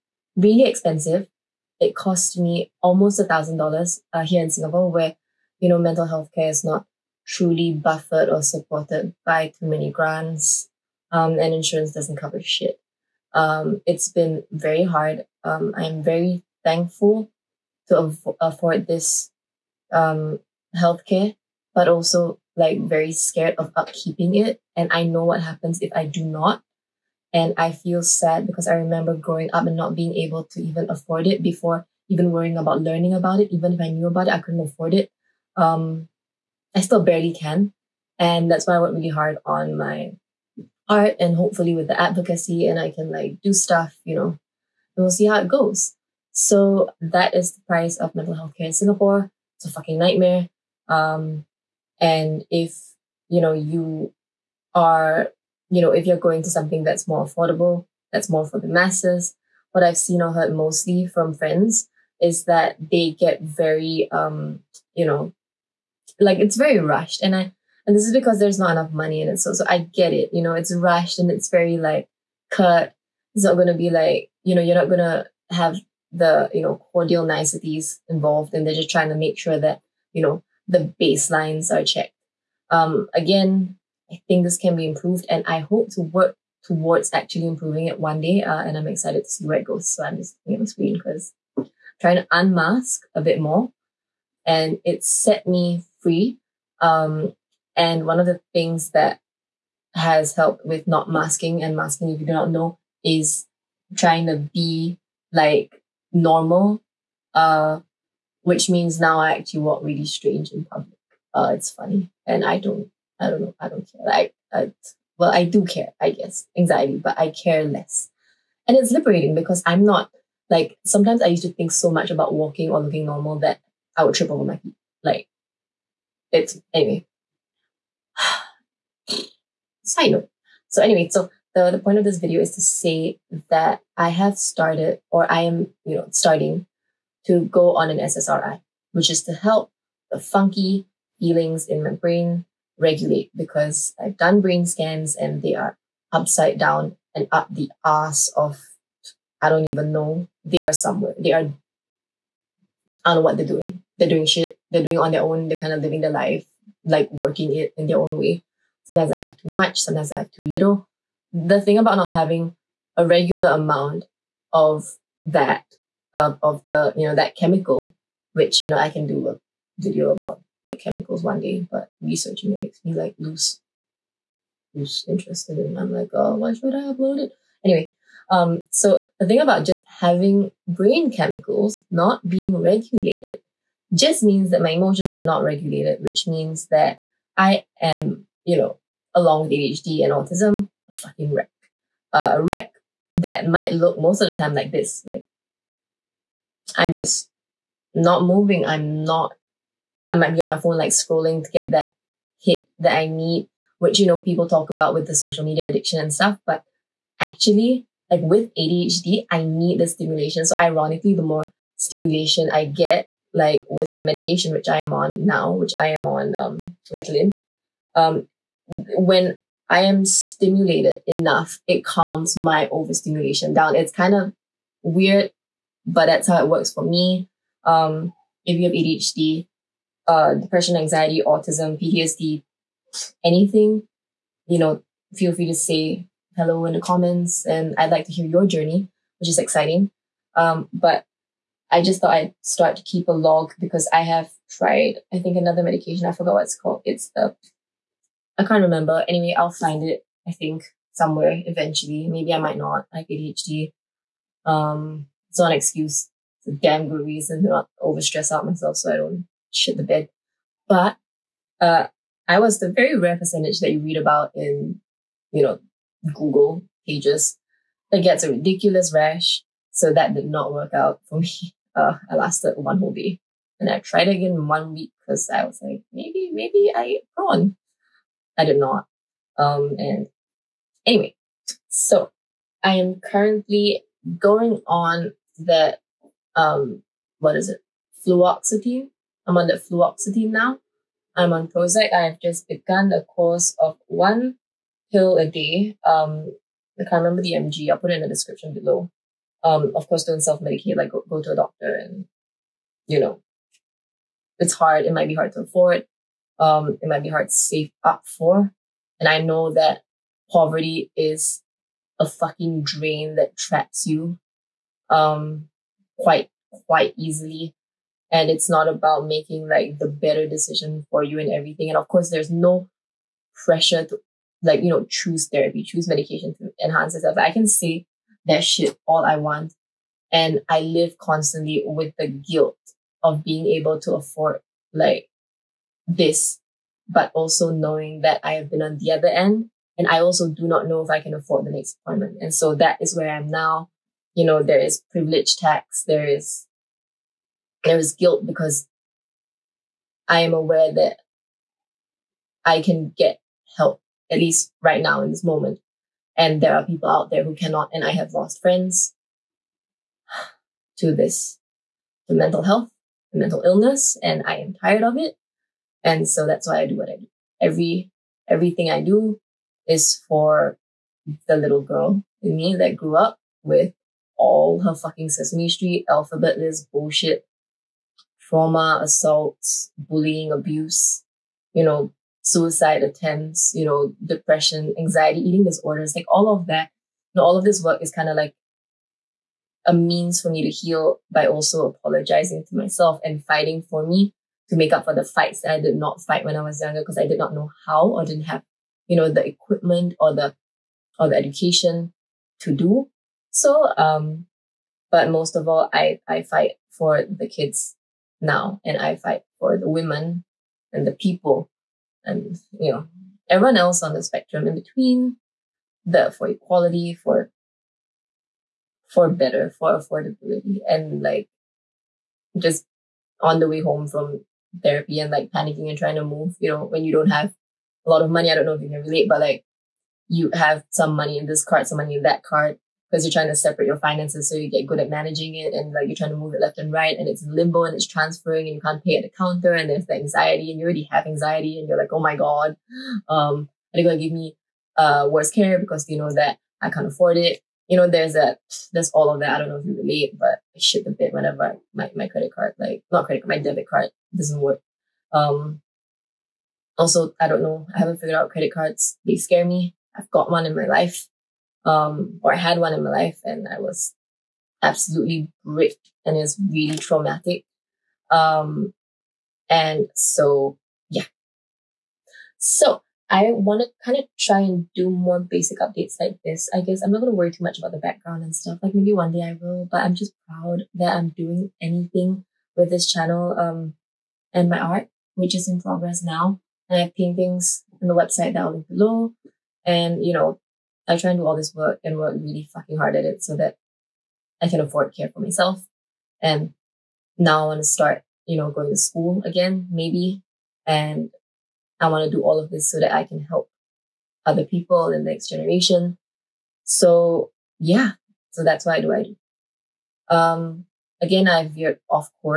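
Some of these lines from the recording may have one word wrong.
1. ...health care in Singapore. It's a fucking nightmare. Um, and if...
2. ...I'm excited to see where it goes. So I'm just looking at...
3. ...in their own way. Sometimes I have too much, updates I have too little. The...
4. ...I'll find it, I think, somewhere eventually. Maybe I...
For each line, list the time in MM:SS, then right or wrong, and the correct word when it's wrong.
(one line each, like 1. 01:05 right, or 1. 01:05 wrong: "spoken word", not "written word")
1. 00:48 right
2. 01:28 right
3. 02:37 wrong: "sometimes", not "updates"
4. 04:09 right.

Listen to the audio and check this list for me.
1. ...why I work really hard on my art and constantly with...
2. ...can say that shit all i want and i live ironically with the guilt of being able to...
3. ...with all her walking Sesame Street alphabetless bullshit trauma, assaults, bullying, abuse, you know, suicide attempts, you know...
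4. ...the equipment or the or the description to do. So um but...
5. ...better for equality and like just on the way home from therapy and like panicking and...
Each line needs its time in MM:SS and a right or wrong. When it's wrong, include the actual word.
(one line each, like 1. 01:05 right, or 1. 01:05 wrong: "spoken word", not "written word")
1. 00:38 wrong: "hopefully", not "constantly"
2. 05:27 wrong: "constantly", not "ironically"
3. 06:13 wrong: "fucking", not "walking"
4. 06:39 wrong: "education", not "description"
5. 06:59 wrong: "affordability", not "equality".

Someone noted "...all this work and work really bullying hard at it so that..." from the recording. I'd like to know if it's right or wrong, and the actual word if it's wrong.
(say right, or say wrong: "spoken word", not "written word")
wrong: "fucking", not "bullying".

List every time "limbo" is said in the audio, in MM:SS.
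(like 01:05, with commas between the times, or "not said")
07:17.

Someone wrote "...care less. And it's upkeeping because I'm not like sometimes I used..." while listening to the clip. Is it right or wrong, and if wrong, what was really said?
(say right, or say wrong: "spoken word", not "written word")
wrong: "liberating", not "upkeeping".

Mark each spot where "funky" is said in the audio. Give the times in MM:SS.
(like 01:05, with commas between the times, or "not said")
02:20.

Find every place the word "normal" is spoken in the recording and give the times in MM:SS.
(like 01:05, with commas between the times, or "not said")
01:46, 02:03.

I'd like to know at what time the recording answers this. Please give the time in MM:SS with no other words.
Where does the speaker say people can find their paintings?
08:07.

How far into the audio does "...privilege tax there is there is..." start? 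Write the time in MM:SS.
05:44.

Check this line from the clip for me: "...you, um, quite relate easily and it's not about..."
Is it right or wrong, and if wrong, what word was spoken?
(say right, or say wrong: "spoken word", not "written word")
wrong: "quite", not "relate".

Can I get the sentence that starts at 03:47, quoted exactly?
Um, if you have ADHD, uh, depression, anxiety, autism, PTSD, anything, you know, feel free to say hello in the comments.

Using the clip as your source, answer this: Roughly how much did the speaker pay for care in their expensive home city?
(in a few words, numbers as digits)
almost $1,000.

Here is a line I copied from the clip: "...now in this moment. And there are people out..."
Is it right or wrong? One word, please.
right.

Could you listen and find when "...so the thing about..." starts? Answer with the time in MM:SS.
02:58.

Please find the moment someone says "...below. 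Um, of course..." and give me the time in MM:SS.
04:58.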